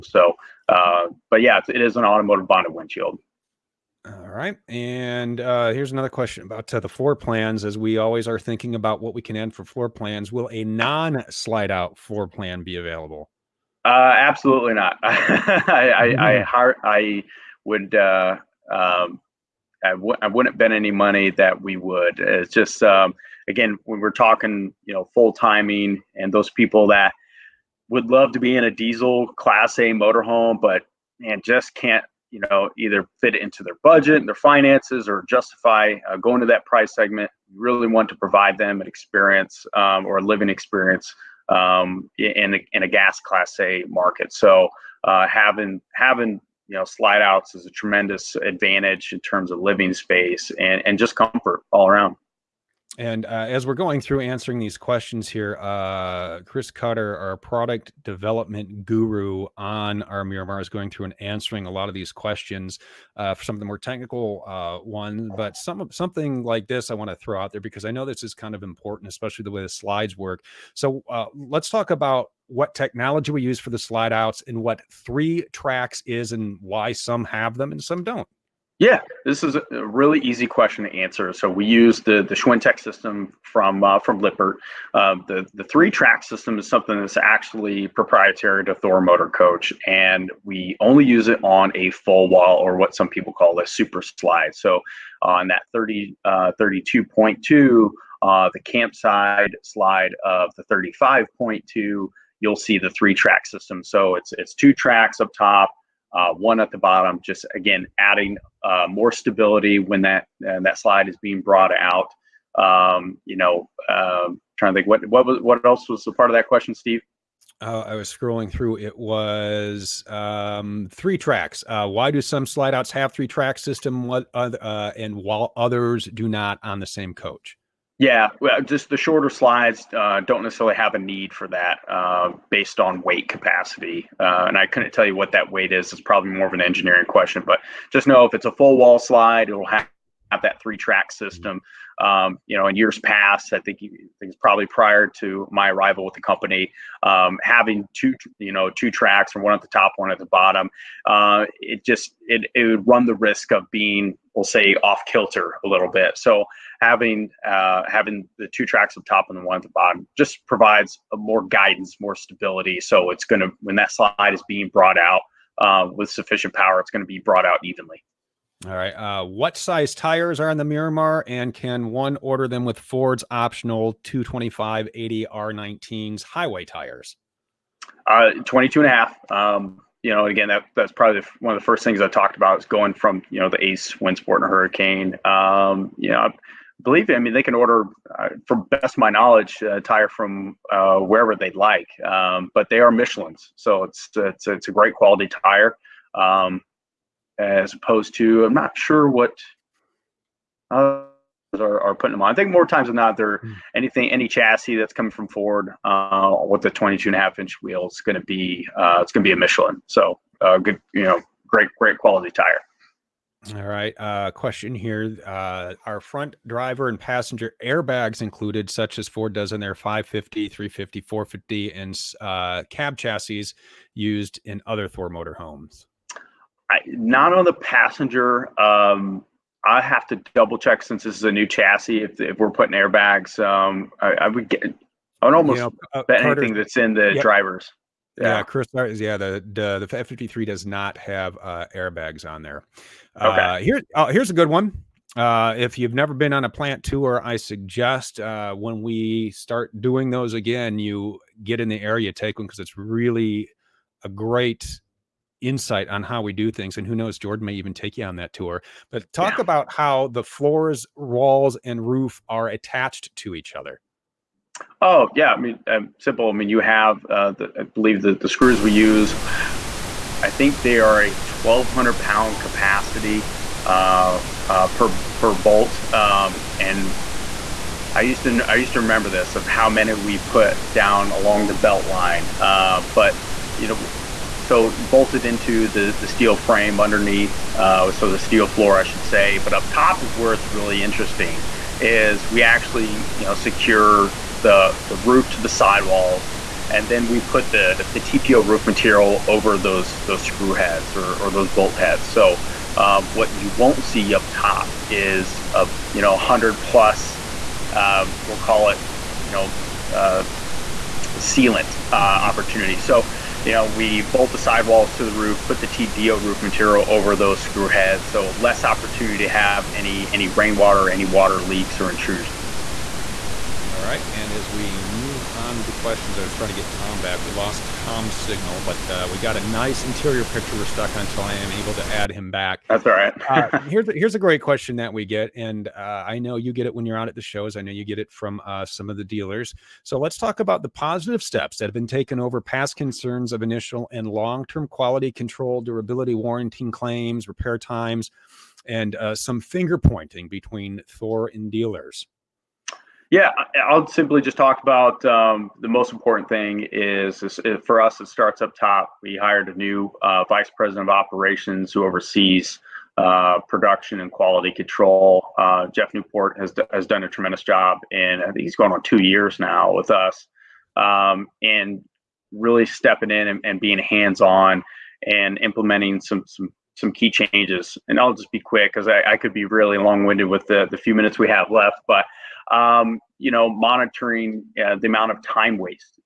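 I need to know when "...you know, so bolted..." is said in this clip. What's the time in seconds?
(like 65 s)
283 s.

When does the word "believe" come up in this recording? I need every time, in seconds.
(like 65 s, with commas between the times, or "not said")
186 s, 267 s.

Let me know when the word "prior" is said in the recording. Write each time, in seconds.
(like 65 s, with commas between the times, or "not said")
144 s.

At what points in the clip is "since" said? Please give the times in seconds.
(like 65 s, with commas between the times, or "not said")
230 s.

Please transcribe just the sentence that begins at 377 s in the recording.
And I'll just be quick because I, I, could be really long winded with the, the few minutes we have left.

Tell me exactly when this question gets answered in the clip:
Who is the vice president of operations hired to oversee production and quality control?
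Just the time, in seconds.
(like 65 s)
365 s.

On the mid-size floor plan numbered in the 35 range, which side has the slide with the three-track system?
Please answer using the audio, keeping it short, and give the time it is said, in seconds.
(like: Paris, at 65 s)
campside, at 98 s.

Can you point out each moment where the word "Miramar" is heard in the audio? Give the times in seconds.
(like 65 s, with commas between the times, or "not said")
60 s, 170 s.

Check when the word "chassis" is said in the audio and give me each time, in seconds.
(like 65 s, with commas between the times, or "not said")
204 s, 222 s, 231 s.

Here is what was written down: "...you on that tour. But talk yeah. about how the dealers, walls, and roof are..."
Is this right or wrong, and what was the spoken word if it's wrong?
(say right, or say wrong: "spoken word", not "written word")
wrong: "floors", not "dealers".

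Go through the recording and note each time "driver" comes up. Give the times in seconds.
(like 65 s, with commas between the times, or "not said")
216 s, 237 s.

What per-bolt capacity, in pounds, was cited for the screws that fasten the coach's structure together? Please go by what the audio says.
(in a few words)
1,200 pounds.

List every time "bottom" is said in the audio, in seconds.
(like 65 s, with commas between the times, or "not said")
106 s, 150 s, 159 s.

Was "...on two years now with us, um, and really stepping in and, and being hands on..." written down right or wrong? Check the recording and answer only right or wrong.
right.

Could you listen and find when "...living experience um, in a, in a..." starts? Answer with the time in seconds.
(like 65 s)
40 s.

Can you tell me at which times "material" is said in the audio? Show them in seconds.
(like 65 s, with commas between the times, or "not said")
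298 s, 316 s.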